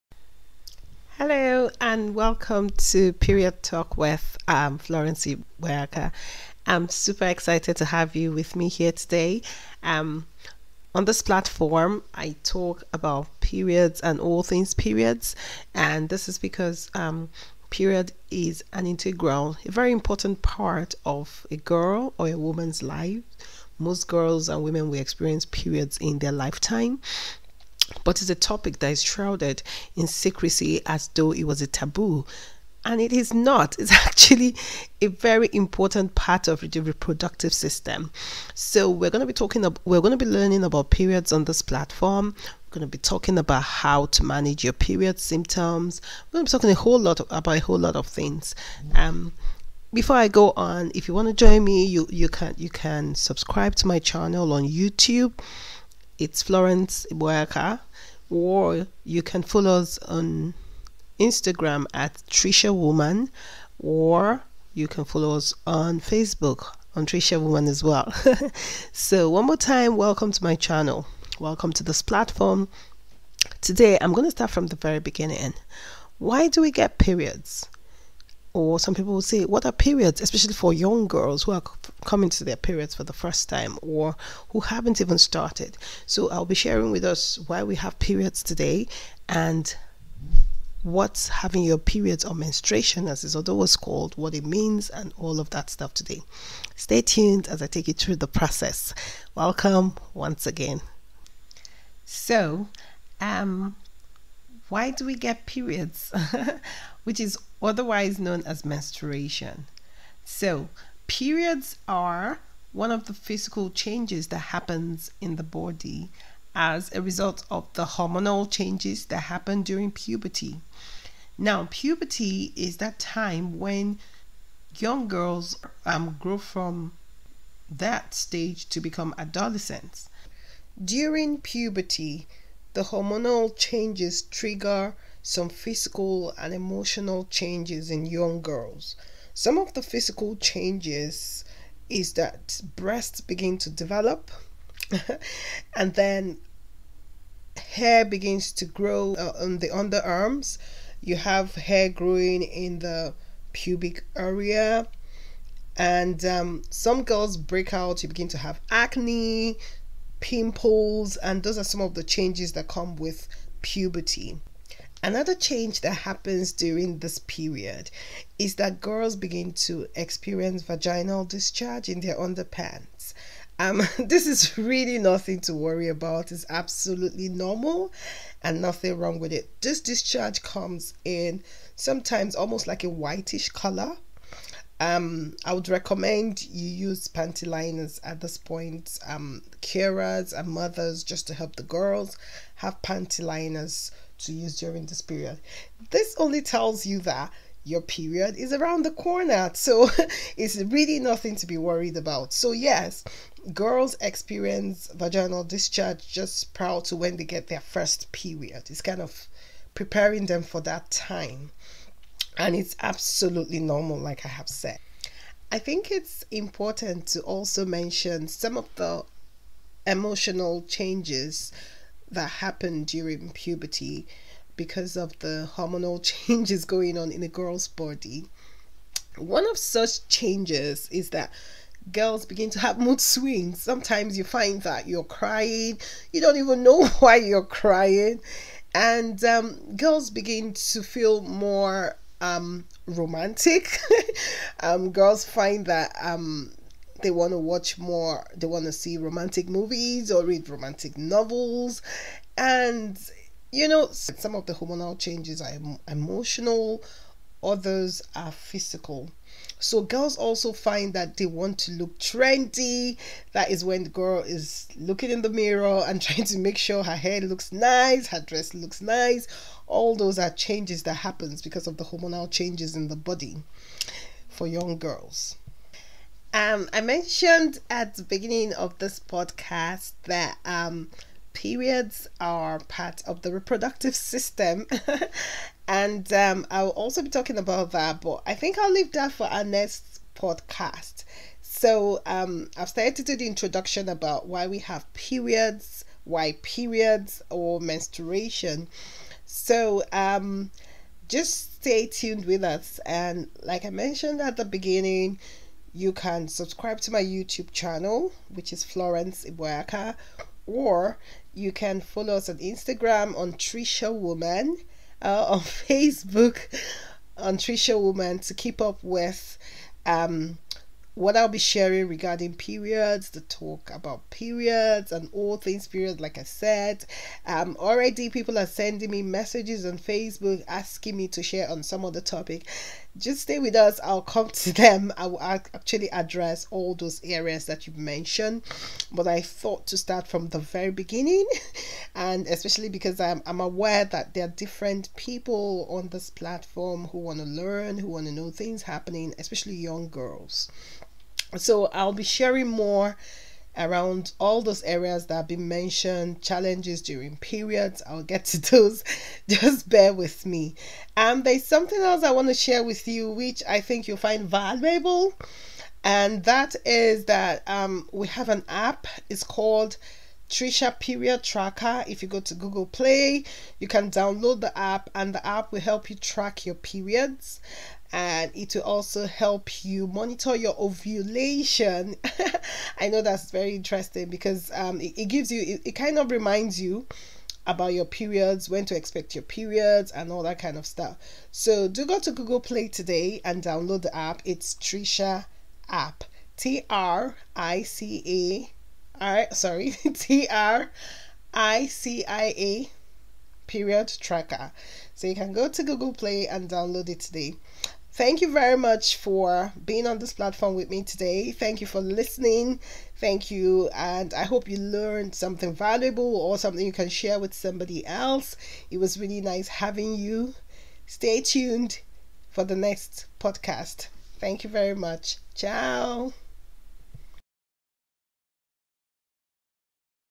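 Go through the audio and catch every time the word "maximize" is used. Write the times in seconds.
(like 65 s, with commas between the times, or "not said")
not said.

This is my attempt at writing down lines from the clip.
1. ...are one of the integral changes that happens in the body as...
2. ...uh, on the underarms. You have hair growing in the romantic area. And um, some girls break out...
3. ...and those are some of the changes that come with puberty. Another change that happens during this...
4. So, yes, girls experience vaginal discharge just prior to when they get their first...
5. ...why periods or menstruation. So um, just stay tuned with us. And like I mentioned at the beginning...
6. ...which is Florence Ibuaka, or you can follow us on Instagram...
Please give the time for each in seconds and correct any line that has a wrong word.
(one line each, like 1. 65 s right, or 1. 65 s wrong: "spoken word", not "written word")
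1. 111 s wrong: "physical", not "integral"
2. 149 s wrong: "pubic", not "romantic"
3. 161 s right
4. 202 s right
5. 296 s right
6. 308 s right.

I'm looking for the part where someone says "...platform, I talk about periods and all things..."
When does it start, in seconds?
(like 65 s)
11 s.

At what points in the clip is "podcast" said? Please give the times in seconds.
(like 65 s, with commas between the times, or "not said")
279 s, 290 s, 423 s.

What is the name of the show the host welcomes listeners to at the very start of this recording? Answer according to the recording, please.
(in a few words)
Period Talk.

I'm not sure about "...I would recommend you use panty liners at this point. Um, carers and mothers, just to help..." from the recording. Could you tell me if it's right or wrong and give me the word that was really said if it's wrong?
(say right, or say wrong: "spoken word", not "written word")
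right.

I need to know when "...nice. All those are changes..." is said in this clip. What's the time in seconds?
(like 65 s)
268 s.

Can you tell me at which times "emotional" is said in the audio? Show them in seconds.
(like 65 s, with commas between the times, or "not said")
136 s, 219 s, 255 s.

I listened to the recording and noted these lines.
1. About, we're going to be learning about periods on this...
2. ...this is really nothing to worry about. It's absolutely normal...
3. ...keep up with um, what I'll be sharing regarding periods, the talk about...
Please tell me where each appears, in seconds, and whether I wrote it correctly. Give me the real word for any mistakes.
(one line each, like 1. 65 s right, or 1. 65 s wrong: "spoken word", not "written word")
1. 39 s right
2. 173 s right
3. 318 s right.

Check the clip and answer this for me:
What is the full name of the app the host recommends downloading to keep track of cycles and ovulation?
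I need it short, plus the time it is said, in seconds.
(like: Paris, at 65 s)
Tricia Period Tracker, at 370 s.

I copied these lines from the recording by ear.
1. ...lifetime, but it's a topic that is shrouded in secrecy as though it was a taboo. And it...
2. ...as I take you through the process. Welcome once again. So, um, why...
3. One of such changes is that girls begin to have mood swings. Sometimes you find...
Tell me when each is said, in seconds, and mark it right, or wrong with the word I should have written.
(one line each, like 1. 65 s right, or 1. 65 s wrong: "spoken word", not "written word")
1. 26 s right
2. 97 s right
3. 229 s right.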